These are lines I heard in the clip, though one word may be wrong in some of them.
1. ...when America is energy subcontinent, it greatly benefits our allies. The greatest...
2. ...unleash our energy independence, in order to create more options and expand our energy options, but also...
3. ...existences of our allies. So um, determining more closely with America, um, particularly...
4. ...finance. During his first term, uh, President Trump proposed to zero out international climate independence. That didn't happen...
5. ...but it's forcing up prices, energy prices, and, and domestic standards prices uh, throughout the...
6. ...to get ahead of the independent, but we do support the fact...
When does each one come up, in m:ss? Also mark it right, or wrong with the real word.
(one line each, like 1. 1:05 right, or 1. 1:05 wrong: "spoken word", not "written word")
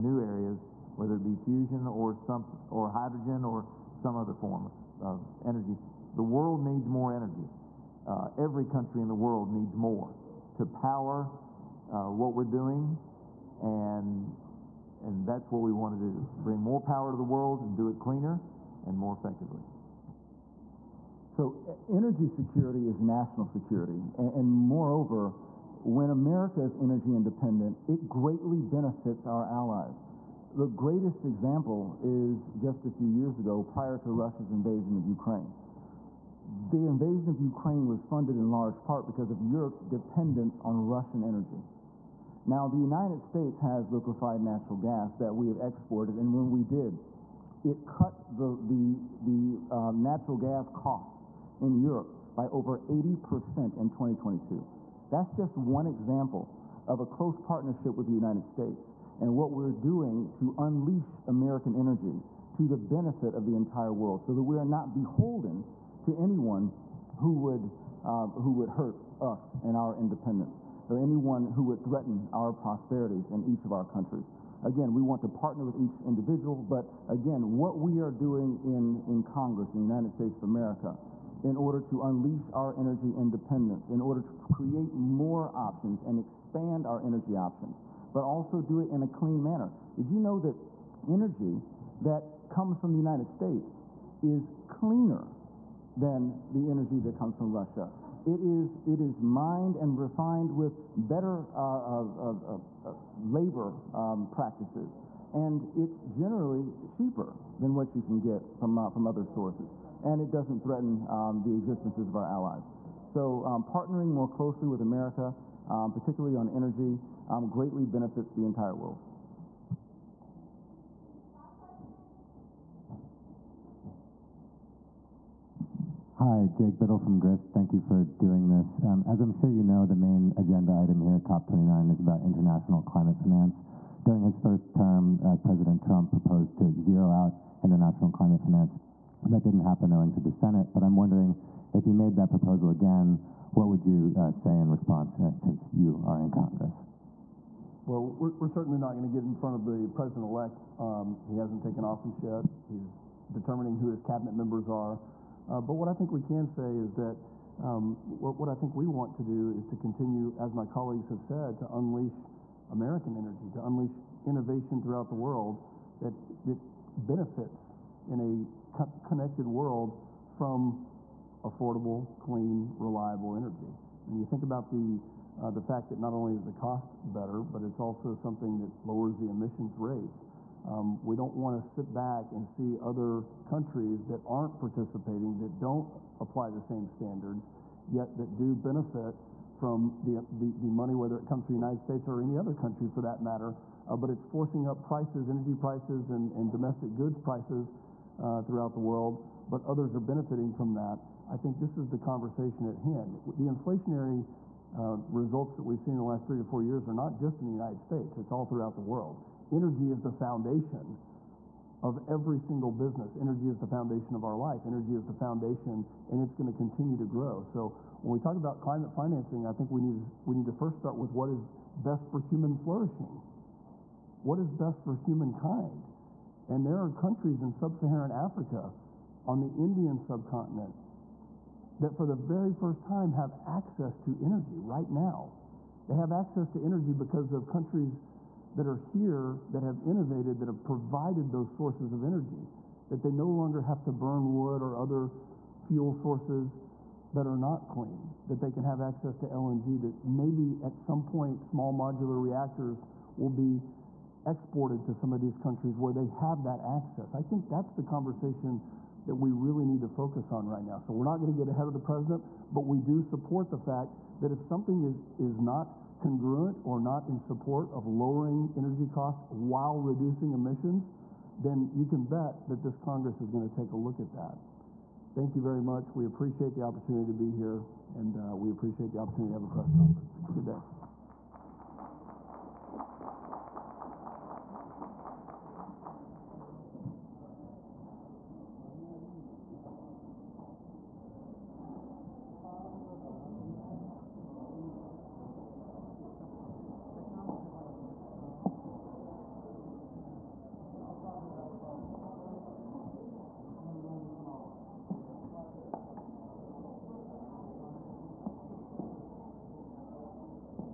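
1. 0:25 wrong: "independent", not "subcontinent"
2. 1:22 right
3. 1:51 wrong: "partnering", not "determining"
4. 2:13 wrong: "finance", not "independence"
5. 3:13 wrong: "goods", not "standards"
6. 4:21 wrong: "president", not "independent".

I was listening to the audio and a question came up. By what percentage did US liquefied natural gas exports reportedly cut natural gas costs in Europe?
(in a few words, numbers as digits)
over 80%.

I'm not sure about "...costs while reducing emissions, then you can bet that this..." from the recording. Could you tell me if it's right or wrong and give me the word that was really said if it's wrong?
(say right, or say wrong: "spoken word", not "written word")
right.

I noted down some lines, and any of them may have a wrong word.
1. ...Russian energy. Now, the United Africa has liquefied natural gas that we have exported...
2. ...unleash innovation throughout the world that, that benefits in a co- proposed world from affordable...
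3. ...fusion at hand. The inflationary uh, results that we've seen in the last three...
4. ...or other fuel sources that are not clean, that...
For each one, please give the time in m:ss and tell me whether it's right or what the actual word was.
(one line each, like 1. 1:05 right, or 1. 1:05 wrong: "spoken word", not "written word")
1. 0:40 wrong: "States", not "Africa"
2. 2:43 wrong: "connected", not "proposed"
3. 3:21 wrong: "conversation", not "fusion"
4. 4:04 right.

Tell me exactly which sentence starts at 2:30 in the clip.
Um, he hasn't taken office yet.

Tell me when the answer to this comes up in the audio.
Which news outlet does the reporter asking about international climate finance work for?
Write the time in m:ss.
2:07.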